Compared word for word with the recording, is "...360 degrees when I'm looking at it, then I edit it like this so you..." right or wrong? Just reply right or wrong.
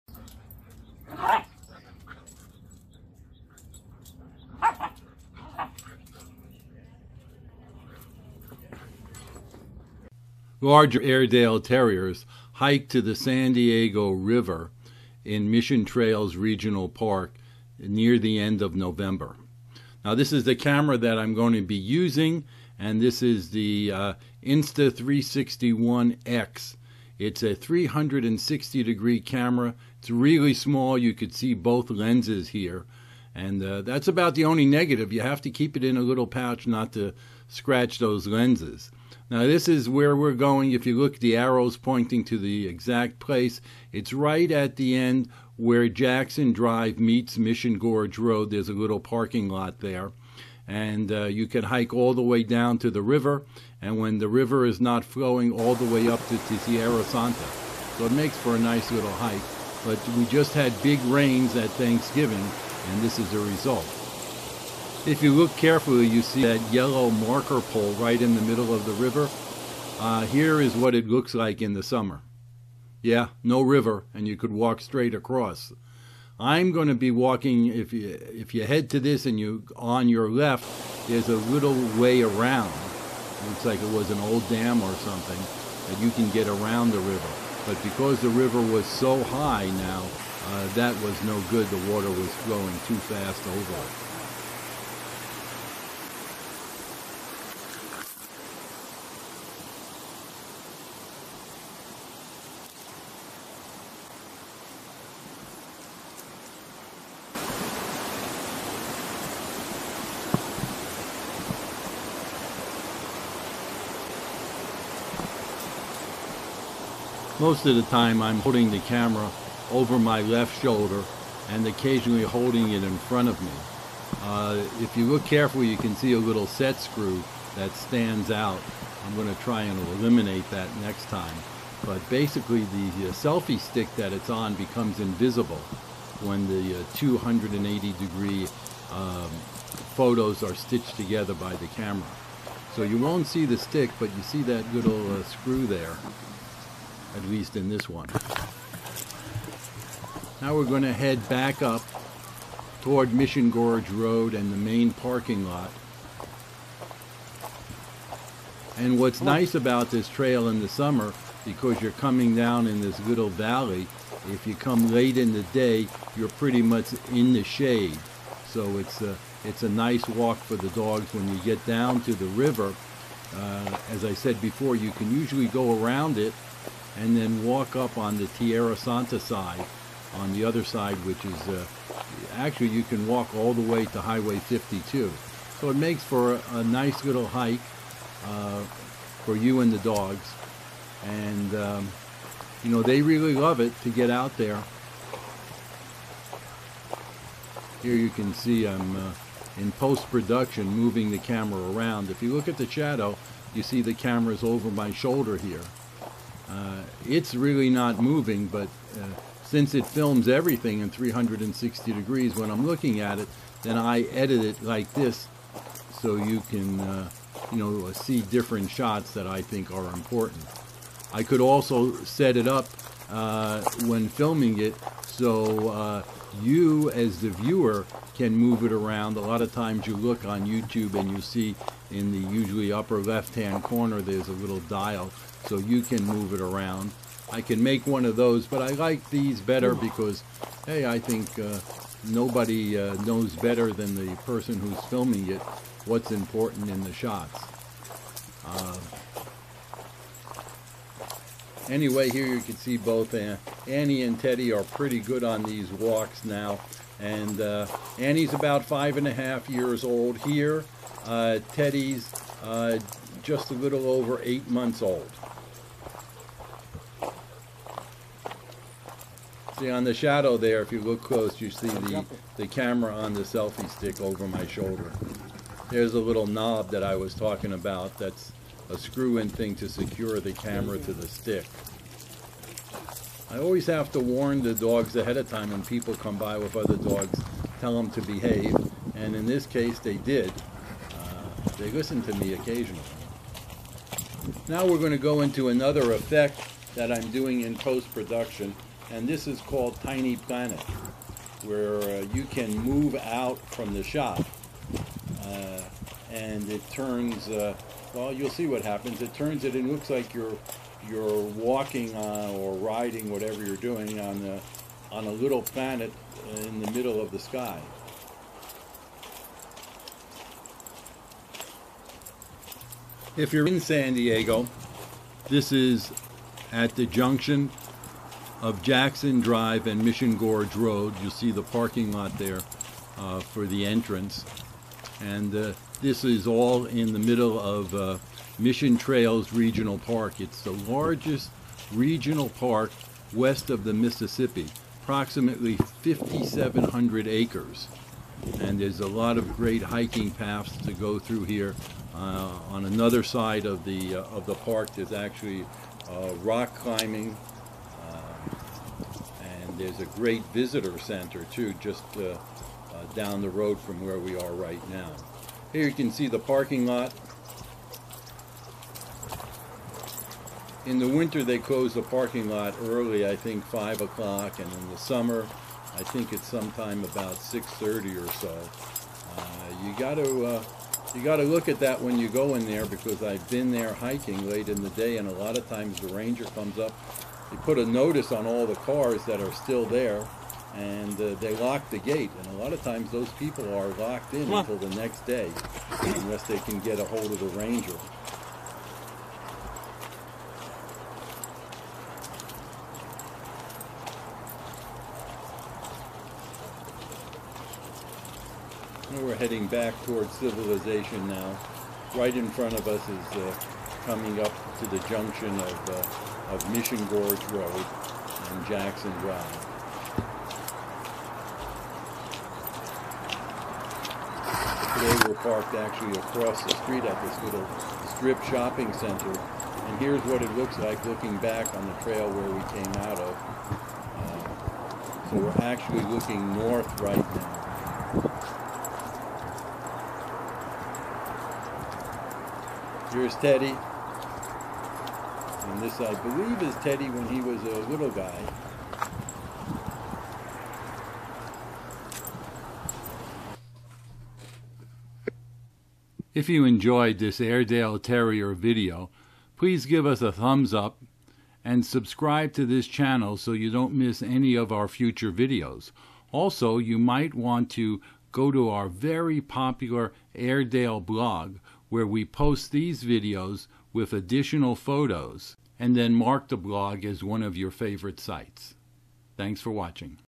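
right.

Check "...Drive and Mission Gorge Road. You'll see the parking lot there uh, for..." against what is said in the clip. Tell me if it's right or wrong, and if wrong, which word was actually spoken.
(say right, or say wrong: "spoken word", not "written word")
right.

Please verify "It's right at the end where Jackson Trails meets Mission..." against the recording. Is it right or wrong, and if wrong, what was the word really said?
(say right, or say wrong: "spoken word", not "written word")
wrong: "Drive", not "Trails".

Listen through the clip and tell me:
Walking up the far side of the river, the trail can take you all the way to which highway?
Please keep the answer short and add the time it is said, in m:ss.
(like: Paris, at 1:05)
Highway 52, at 3:04.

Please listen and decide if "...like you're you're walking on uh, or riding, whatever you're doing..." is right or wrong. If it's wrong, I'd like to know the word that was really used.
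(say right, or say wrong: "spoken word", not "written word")
right.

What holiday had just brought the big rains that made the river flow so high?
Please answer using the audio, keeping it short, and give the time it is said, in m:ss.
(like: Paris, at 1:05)
Thanksgiving, at 1:01.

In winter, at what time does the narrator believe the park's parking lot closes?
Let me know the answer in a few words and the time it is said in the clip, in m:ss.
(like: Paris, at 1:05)
5 o'clock, at 6:13.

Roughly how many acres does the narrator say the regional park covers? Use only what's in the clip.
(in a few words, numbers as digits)
5,700 acres.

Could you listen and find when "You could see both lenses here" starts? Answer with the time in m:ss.
0:30.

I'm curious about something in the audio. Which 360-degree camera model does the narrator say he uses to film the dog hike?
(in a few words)
Insta361X.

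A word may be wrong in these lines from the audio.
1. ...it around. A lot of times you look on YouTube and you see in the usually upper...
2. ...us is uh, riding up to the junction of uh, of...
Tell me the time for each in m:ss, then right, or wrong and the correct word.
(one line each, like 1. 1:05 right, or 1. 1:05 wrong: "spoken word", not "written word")
1. 3:48 right
2. 6:52 wrong: "coming", not "riding".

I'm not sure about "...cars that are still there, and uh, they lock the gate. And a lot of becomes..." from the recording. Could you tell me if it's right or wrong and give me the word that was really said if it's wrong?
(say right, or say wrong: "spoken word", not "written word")
wrong: "times", not "becomes".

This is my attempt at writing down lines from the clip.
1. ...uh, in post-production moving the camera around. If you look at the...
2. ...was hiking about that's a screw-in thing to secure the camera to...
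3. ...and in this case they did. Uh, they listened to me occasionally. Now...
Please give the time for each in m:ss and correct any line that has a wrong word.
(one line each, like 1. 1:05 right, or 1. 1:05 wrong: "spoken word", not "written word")
1. 3:18 right
2. 4:36 wrong: "talking", not "hiking"
3. 4:48 right.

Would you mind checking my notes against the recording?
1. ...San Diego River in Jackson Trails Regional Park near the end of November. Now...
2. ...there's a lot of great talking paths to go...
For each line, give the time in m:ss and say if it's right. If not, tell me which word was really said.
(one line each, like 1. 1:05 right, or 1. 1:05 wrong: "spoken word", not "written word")
1. 0:13 wrong: "Mission", not "Jackson"
2. 5:48 wrong: "hiking", not "talking".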